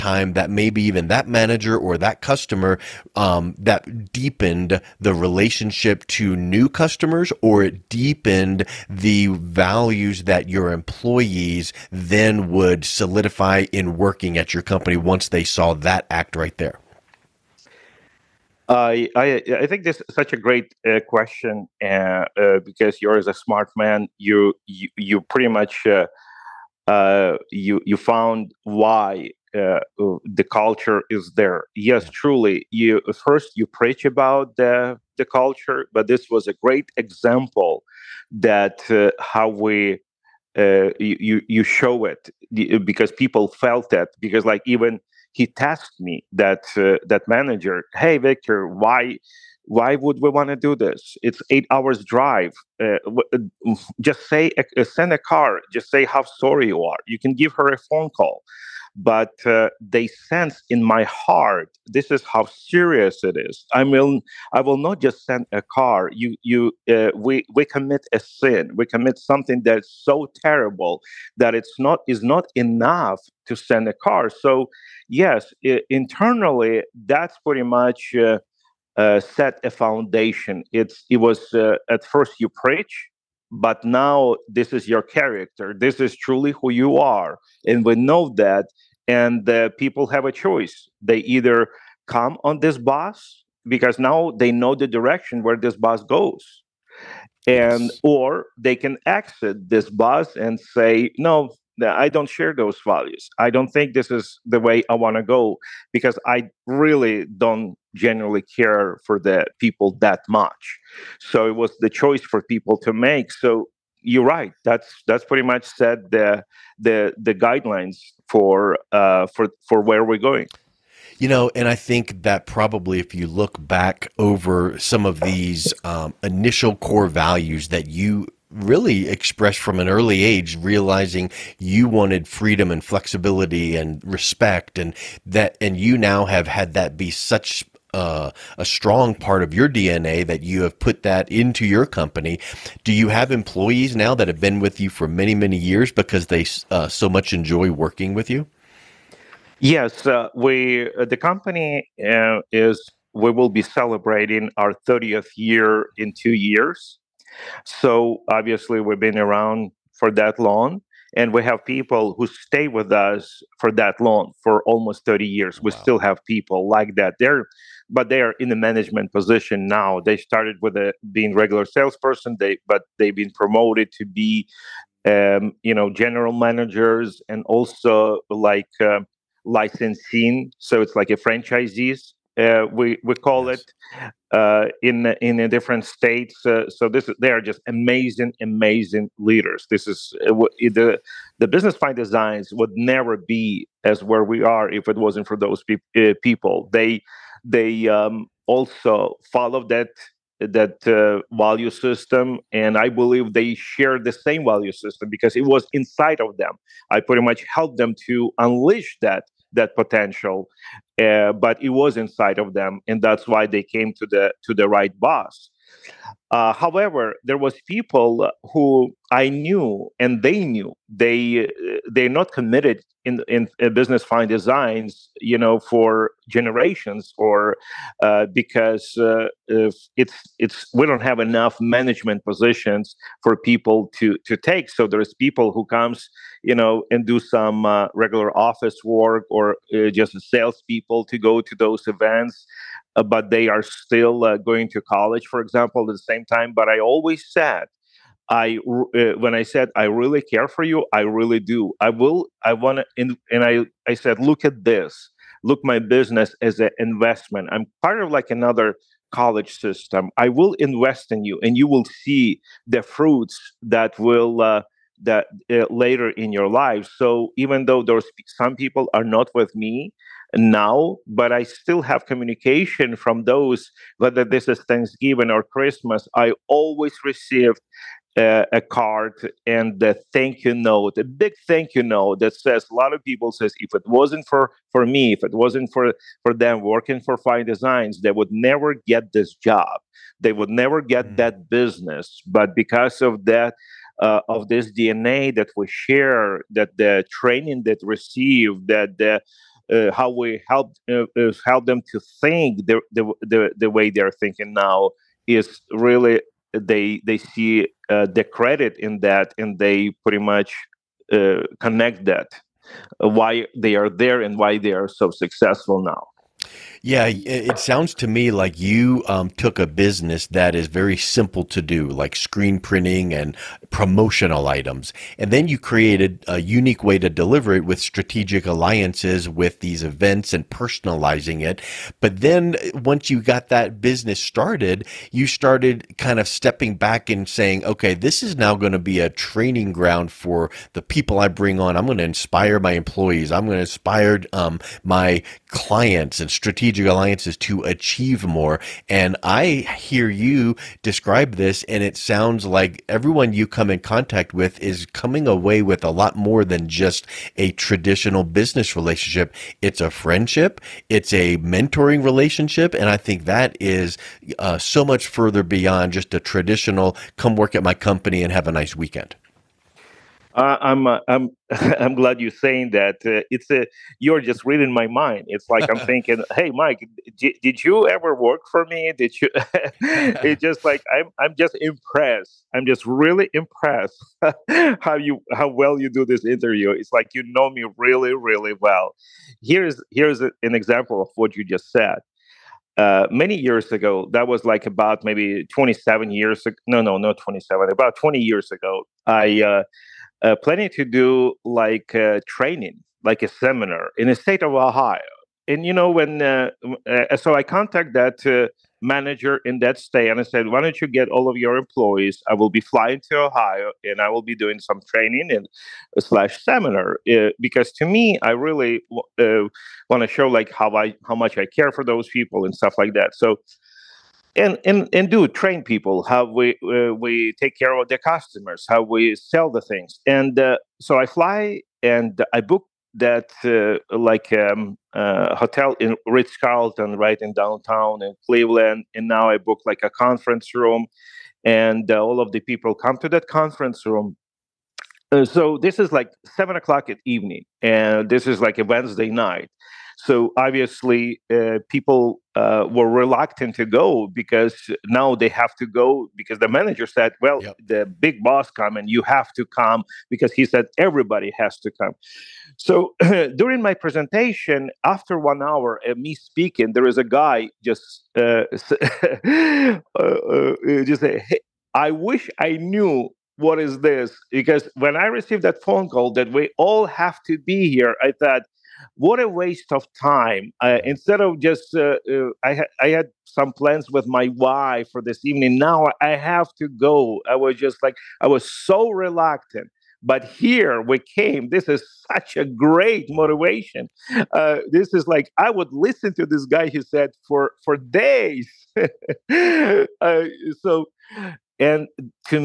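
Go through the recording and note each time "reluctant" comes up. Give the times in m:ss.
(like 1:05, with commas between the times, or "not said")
7:32, 8:08.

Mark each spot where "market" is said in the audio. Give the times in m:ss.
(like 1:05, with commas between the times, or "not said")
not said.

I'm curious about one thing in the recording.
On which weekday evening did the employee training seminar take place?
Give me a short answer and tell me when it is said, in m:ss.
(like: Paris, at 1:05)
Wednesday, at 7:28.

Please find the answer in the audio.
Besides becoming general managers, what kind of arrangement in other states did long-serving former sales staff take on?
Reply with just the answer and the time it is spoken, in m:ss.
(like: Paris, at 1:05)
Licensing, at 2:59.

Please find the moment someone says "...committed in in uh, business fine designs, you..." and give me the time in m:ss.
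3:42.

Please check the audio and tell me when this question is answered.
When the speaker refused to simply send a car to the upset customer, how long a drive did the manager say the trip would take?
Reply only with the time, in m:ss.
0:51.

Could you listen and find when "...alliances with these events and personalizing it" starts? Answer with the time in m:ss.
5:28.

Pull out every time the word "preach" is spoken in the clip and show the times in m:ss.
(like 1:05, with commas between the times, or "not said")
0:33, 1:22.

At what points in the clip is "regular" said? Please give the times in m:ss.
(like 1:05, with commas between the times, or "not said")
2:51, 3:57.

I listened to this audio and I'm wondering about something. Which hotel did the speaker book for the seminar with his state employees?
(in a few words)
Ritz Carlton.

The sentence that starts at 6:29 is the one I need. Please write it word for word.
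Here's here's a, an example of what you just said.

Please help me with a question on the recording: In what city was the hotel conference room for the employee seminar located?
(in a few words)
Cleveland.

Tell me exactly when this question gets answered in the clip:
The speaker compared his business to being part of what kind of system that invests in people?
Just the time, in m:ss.
4:19.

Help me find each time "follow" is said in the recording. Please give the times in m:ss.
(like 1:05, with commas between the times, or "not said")
3:19.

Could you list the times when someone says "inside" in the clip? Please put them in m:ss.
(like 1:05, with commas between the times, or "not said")
3:25, 3:31.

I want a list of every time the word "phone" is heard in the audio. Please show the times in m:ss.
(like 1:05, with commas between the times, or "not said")
0:57, 7:55.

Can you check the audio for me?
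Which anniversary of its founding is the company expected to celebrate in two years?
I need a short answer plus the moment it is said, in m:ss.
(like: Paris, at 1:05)
30th, at 2:34.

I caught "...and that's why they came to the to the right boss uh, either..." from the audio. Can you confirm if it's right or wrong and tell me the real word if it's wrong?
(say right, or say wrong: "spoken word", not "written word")
wrong: "however", not "either".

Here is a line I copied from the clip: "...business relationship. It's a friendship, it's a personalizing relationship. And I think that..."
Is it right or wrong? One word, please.
wrong.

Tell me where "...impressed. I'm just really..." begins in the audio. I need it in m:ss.
6:21.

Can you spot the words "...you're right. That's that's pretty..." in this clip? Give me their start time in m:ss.
1:54.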